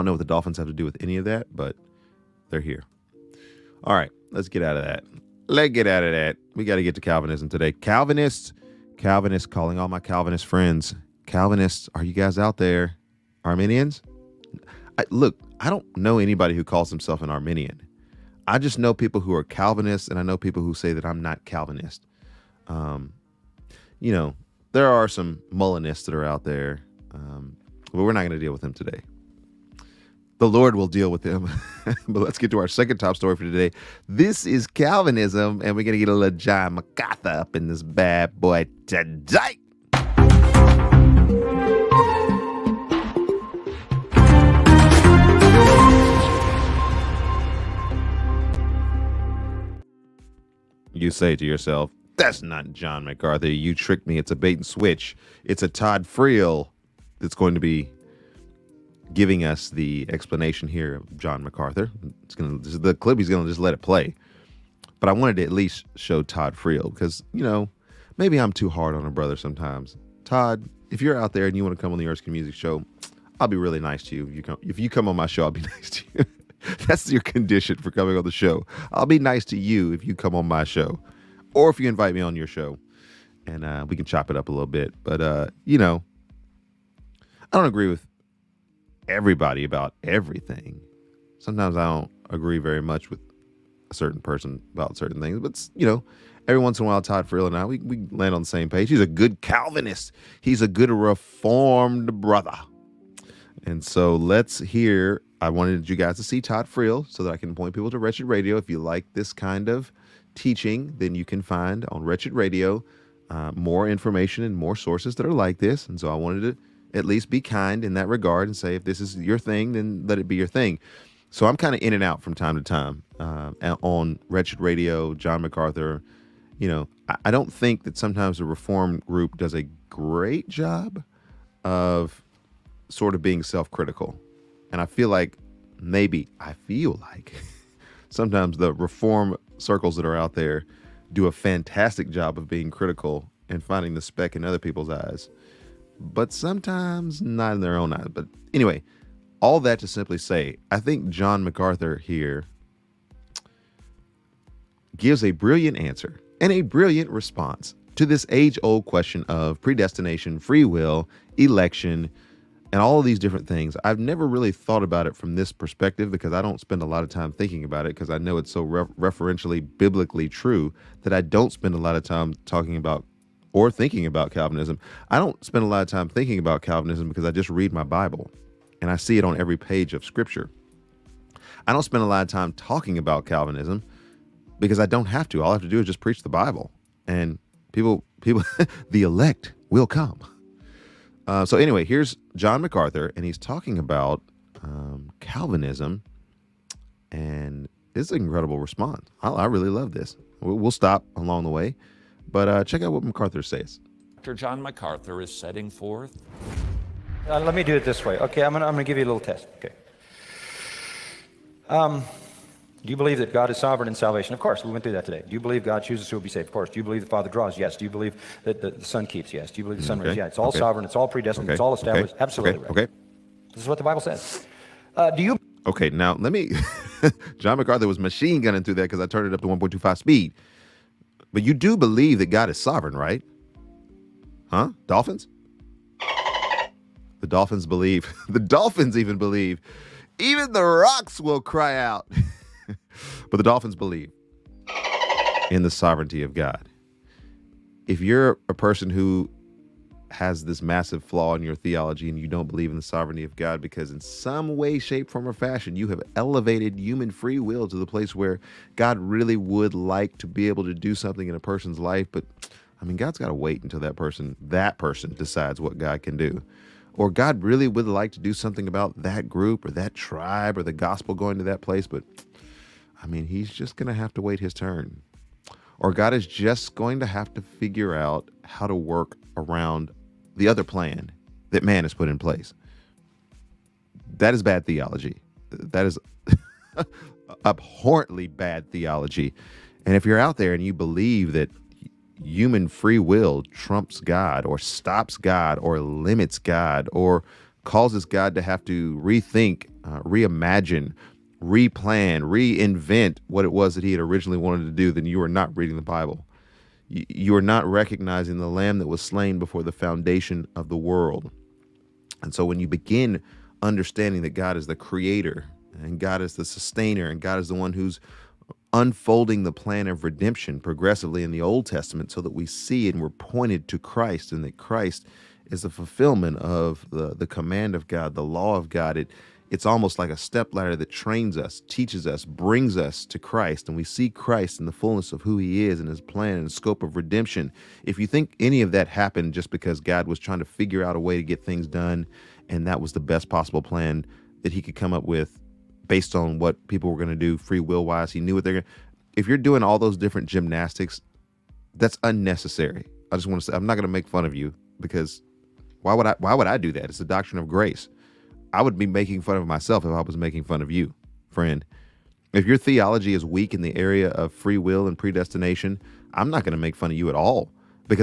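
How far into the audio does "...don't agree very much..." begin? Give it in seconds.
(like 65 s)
91 s.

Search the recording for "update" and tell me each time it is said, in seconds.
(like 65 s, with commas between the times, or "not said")
not said.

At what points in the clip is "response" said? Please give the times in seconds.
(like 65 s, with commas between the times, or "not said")
157 s, 198 s.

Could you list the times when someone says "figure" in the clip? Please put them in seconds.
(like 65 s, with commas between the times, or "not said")
277 s, 340 s.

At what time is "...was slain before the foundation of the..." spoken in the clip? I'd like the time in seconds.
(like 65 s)
308 s.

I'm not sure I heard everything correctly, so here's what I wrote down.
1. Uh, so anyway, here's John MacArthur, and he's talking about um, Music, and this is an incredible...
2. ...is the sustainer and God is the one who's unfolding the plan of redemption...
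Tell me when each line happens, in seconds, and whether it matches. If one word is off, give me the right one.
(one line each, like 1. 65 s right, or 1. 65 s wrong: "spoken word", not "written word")
1. 191 s wrong: "Calvinism", not "Music"
2. 316 s right.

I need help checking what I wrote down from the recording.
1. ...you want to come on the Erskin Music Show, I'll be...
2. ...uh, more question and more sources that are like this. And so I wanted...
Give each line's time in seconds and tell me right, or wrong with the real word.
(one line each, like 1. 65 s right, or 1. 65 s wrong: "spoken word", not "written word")
1. 71 s right
2. 113 s wrong: "information", not "question".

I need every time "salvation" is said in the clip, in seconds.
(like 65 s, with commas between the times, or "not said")
213 s.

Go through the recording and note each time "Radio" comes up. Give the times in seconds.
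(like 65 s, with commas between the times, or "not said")
108 s, 112 s, 124 s.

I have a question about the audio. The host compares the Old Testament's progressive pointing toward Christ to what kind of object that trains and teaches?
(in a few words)
A stepladder.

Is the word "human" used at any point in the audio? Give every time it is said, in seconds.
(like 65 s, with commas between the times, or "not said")
256 s, 292 s.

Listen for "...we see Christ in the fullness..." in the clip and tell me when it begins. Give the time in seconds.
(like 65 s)
333 s.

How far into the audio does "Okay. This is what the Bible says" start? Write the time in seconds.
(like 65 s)
222 s.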